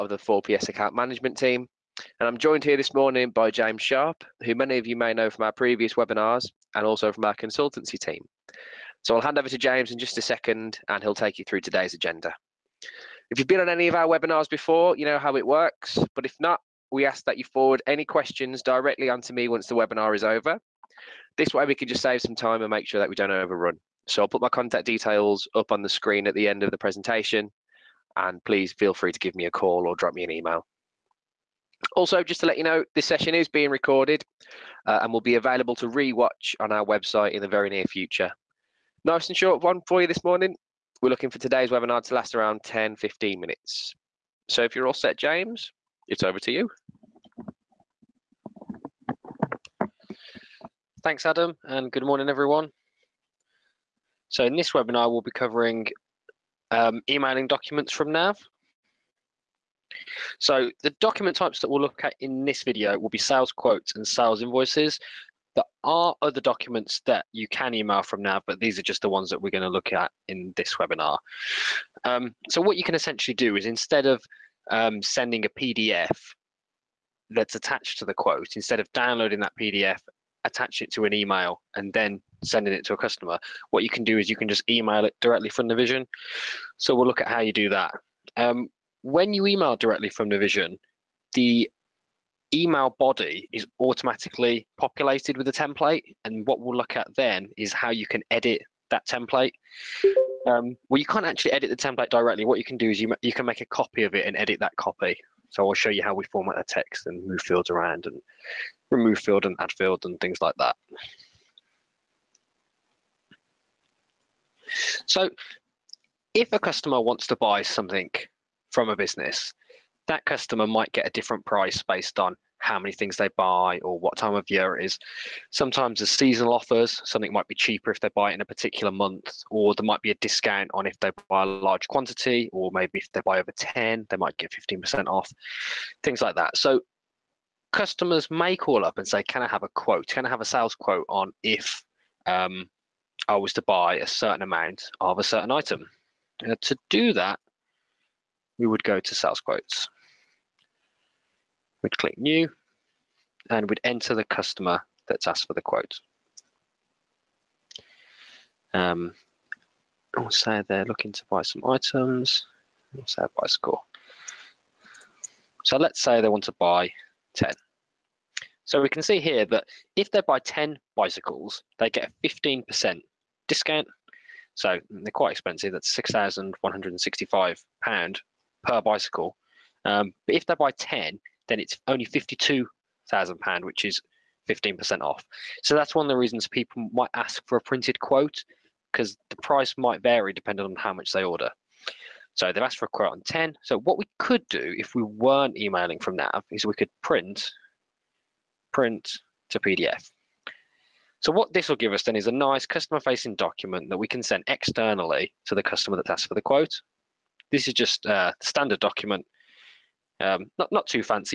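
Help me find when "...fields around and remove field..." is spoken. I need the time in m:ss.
1:47.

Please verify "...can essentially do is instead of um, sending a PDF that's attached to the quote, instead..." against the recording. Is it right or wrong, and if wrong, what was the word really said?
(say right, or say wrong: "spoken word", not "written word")
right.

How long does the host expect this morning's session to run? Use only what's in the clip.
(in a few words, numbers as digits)
10, 15 minutes.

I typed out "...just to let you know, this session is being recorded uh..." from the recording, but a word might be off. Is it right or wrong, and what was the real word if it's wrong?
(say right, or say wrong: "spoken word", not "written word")
right.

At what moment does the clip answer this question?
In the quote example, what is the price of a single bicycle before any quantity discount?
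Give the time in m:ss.
2:55.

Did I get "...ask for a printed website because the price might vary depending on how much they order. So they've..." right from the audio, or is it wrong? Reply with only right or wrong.
wrong.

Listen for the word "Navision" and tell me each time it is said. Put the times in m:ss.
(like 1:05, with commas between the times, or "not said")
1:25, 1:30.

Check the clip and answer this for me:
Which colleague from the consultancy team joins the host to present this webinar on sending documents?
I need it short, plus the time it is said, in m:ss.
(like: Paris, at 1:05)
James Sharp, at 0:03.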